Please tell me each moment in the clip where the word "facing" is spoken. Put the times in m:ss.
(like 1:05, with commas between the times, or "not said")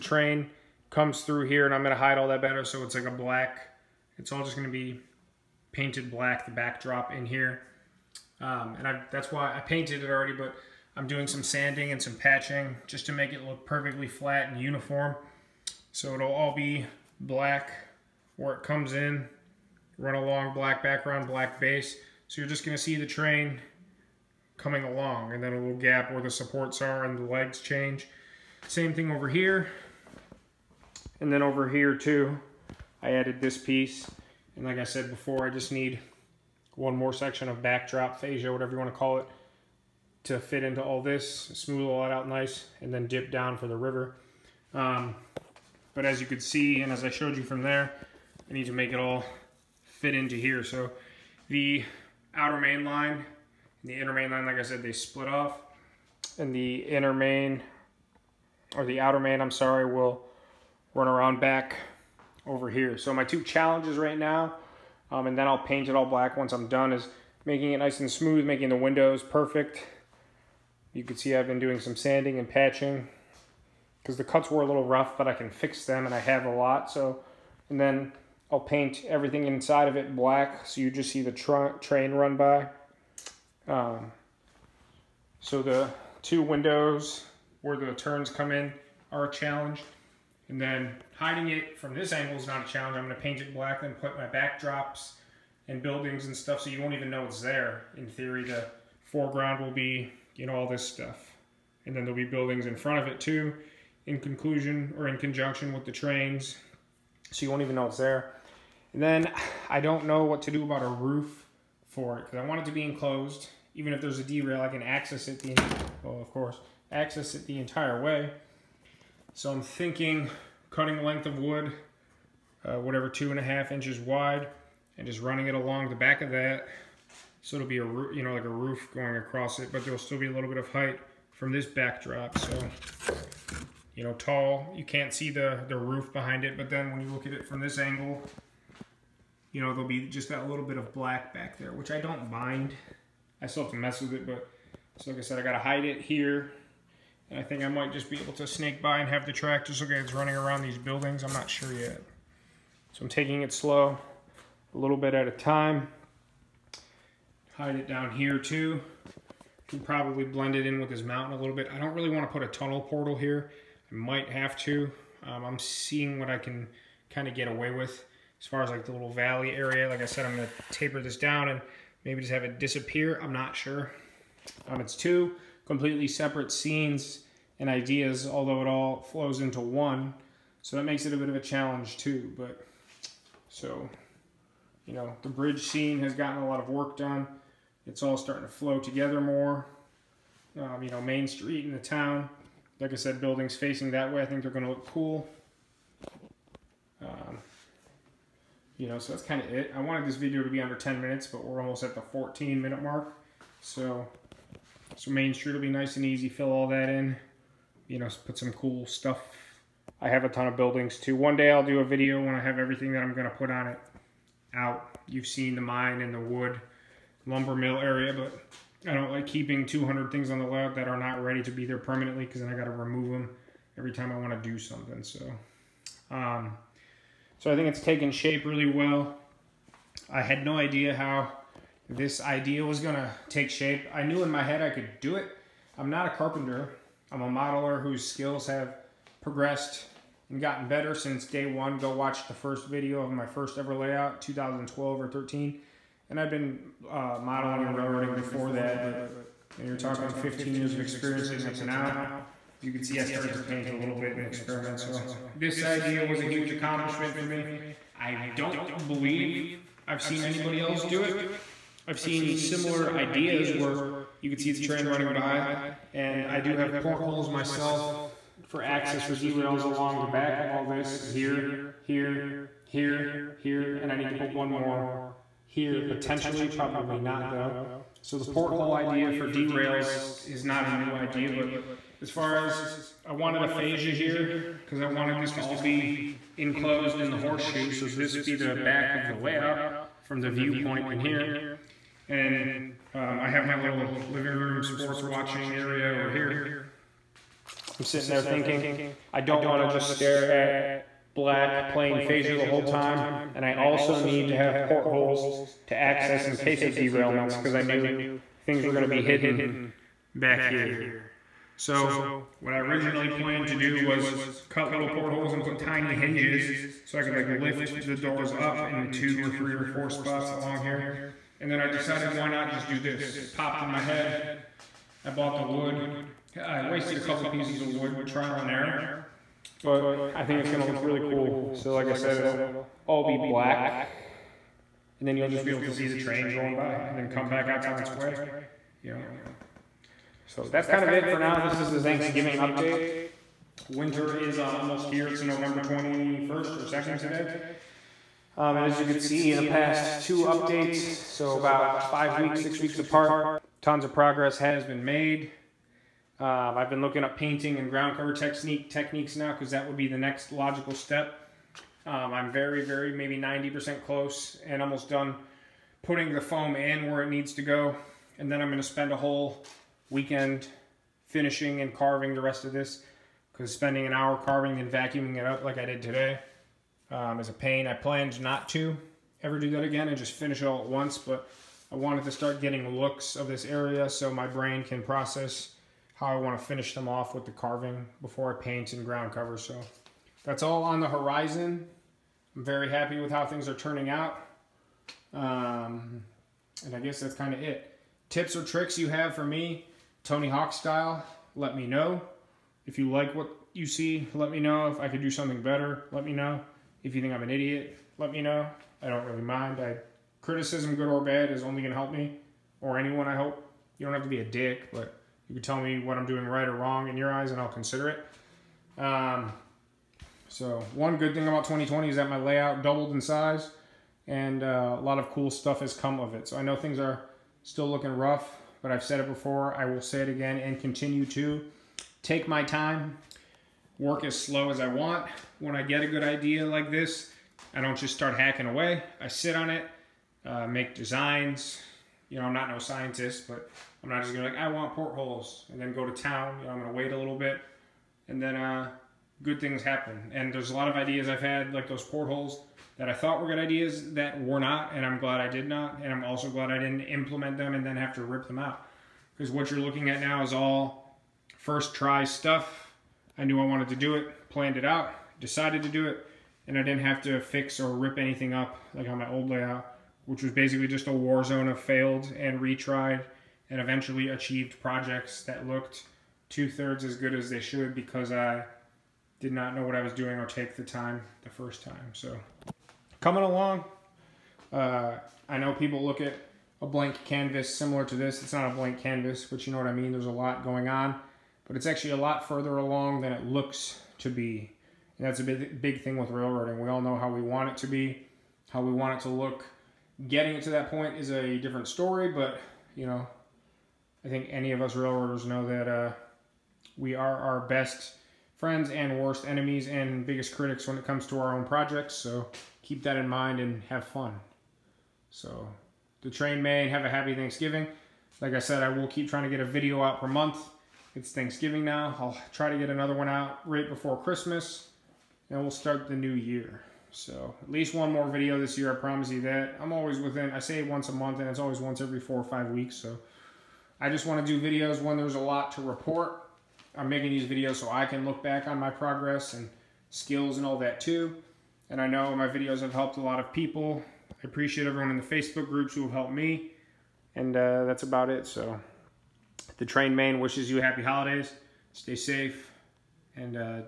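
3:13.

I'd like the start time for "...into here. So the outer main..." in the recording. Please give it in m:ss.
0:50.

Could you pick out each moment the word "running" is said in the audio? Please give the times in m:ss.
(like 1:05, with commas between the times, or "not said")
2:05, 2:30, 4:24.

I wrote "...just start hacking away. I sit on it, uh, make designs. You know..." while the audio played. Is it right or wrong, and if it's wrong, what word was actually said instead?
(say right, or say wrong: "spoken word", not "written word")
right.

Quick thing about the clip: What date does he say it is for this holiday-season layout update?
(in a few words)
November 21st or 22nd.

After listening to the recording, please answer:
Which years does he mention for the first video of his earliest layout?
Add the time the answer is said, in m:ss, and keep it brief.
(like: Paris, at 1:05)
2012 or 2013, at 4:04.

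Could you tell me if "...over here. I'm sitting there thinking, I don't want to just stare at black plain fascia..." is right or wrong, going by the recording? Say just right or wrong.
right.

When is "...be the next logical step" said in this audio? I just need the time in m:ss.
5:59.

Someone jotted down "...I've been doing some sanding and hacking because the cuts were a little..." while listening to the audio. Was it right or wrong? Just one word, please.
wrong.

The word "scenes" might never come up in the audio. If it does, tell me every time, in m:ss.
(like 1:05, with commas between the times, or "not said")
2:56, 3:05.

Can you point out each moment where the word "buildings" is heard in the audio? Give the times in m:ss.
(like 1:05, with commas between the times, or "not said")
1:35, 1:42, 2:30, 3:13, 3:30.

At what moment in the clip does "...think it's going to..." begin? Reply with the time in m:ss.
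5:30.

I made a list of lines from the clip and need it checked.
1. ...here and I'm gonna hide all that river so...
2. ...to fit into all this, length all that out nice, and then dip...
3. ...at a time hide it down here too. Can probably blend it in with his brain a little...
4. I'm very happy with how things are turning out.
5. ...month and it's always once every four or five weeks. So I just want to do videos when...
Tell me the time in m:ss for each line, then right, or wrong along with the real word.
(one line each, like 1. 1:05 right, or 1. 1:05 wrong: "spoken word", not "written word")
1. 0:01 wrong: "better", not "river"
2. 0:40 wrong: "smooth", not "length"
3. 2:35 wrong: "mountain", not "brain"
4. 6:32 right
5. 8:50 right.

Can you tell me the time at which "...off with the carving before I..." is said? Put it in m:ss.
6:26.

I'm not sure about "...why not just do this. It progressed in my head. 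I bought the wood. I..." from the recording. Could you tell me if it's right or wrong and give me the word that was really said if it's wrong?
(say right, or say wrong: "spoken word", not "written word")
wrong: "popped", not "progressed".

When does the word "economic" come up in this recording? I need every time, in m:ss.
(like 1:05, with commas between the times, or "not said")
not said.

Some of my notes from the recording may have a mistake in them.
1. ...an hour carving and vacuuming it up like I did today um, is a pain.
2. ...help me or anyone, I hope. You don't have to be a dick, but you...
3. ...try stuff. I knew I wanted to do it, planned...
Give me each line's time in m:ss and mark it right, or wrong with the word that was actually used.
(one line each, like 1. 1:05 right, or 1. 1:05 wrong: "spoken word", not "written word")
1. 6:13 right
2. 6:51 right
3. 7:41 right.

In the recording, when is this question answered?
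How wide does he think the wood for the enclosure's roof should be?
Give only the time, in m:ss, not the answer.
2:03.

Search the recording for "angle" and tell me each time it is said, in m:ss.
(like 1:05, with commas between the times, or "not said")
1:32, 2:17.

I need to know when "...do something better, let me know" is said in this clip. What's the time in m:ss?
6:45.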